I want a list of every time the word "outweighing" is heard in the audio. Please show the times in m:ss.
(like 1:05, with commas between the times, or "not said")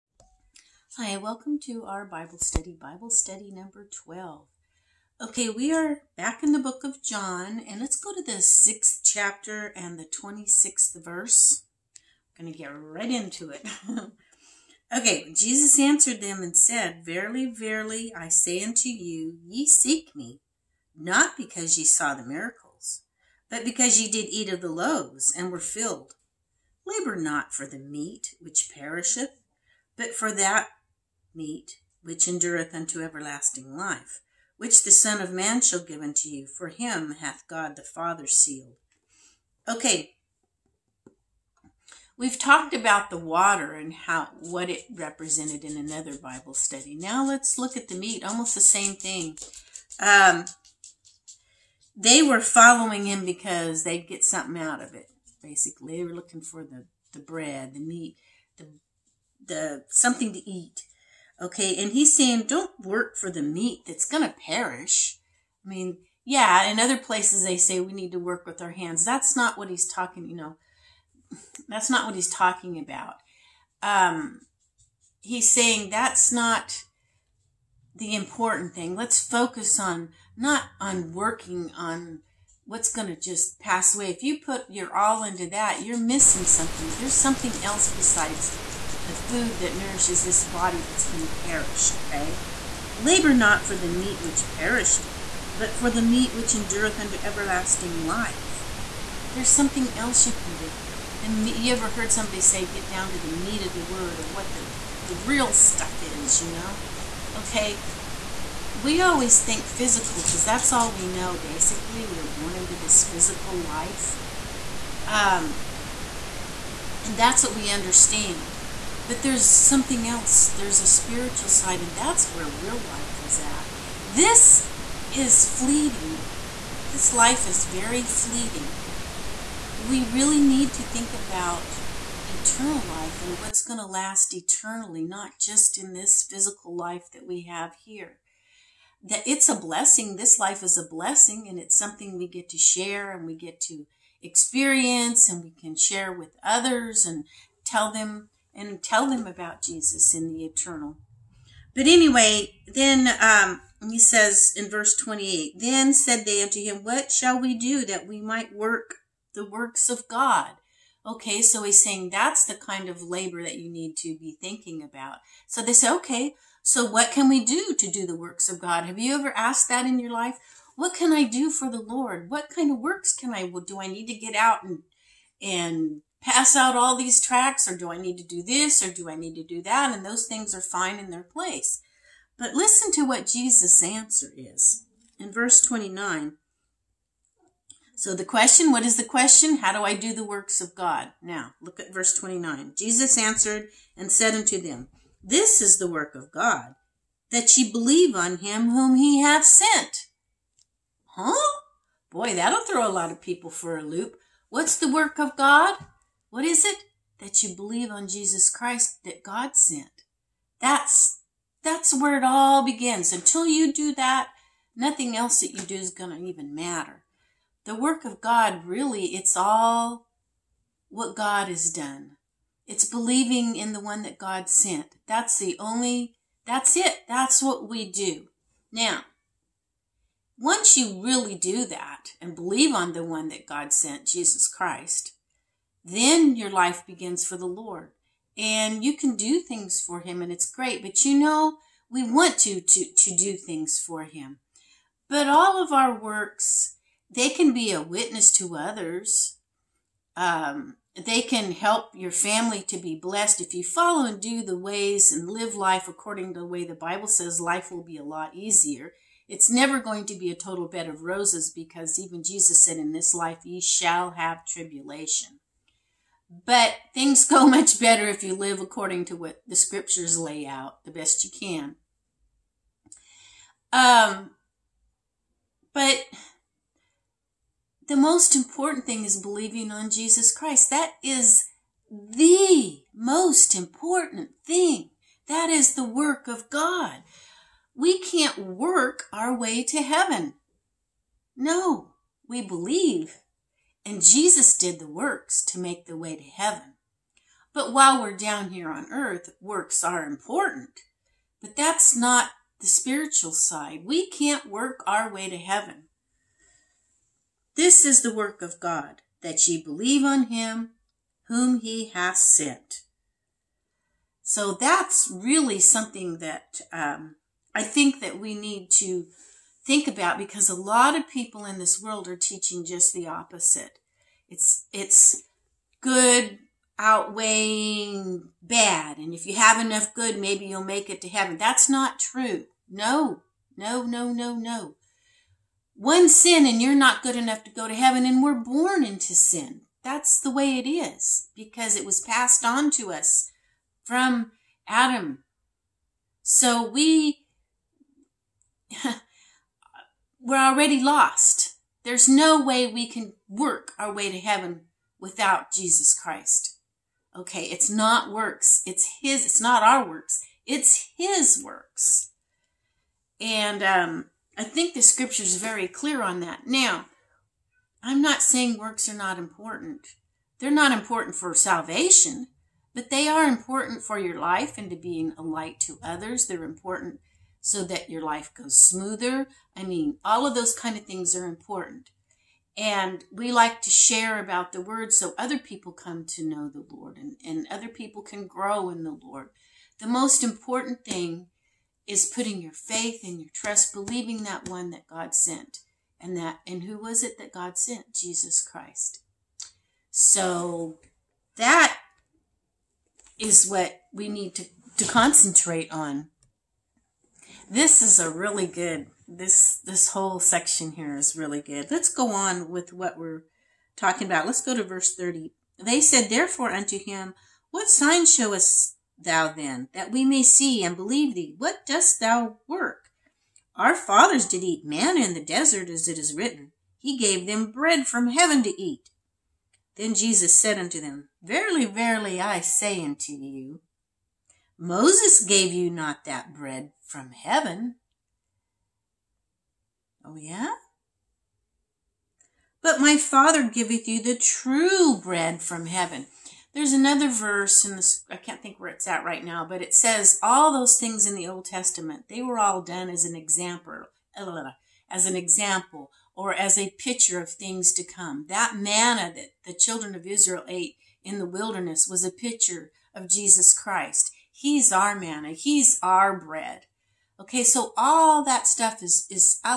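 5:26.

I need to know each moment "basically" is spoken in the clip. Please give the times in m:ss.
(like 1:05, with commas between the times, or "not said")
0:55, 1:51.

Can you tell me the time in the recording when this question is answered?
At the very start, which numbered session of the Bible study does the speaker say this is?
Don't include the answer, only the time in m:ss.
0:02.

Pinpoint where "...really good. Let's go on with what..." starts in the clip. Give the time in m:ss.
6:51.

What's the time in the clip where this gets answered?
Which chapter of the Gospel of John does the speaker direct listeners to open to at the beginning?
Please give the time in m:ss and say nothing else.
0:08.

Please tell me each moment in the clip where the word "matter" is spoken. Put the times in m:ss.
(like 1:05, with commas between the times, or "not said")
3:36.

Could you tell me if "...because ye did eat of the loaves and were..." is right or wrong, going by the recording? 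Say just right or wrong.
right.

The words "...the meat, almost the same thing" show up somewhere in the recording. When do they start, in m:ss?
0:47.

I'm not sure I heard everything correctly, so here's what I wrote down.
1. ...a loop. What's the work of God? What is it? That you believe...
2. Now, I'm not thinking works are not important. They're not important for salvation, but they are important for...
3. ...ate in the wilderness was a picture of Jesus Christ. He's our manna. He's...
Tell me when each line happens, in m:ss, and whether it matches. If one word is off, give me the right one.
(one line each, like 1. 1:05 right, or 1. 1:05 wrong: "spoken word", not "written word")
1. 3:23 right
2. 6:06 wrong: "saying", not "thinking"
3. 7:40 right.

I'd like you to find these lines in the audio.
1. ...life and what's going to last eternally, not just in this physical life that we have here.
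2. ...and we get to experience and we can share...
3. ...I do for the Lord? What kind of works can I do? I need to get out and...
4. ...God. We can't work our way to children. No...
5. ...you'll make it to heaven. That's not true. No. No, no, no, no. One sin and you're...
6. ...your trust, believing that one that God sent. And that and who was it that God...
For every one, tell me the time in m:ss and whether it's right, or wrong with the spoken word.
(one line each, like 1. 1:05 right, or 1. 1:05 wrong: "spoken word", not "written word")
1. 2:12 right
2. 2:23 right
3. 2:51 right
4. 4:46 wrong: "heaven", not "children"
5. 5:30 right
6. 6:33 right.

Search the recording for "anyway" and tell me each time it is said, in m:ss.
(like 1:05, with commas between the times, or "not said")
2:31.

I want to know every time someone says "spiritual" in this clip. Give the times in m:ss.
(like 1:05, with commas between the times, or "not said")
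2:00, 5:02.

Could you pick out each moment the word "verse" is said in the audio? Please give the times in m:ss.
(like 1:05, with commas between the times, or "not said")
0:11, 2:34, 3:05, 3:11, 6:54, 7:27.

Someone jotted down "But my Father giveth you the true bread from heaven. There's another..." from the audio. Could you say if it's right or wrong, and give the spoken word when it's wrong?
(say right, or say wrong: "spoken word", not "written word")
right.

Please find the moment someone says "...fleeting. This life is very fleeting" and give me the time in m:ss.
2:05.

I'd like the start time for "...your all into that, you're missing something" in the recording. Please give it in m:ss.
1:24.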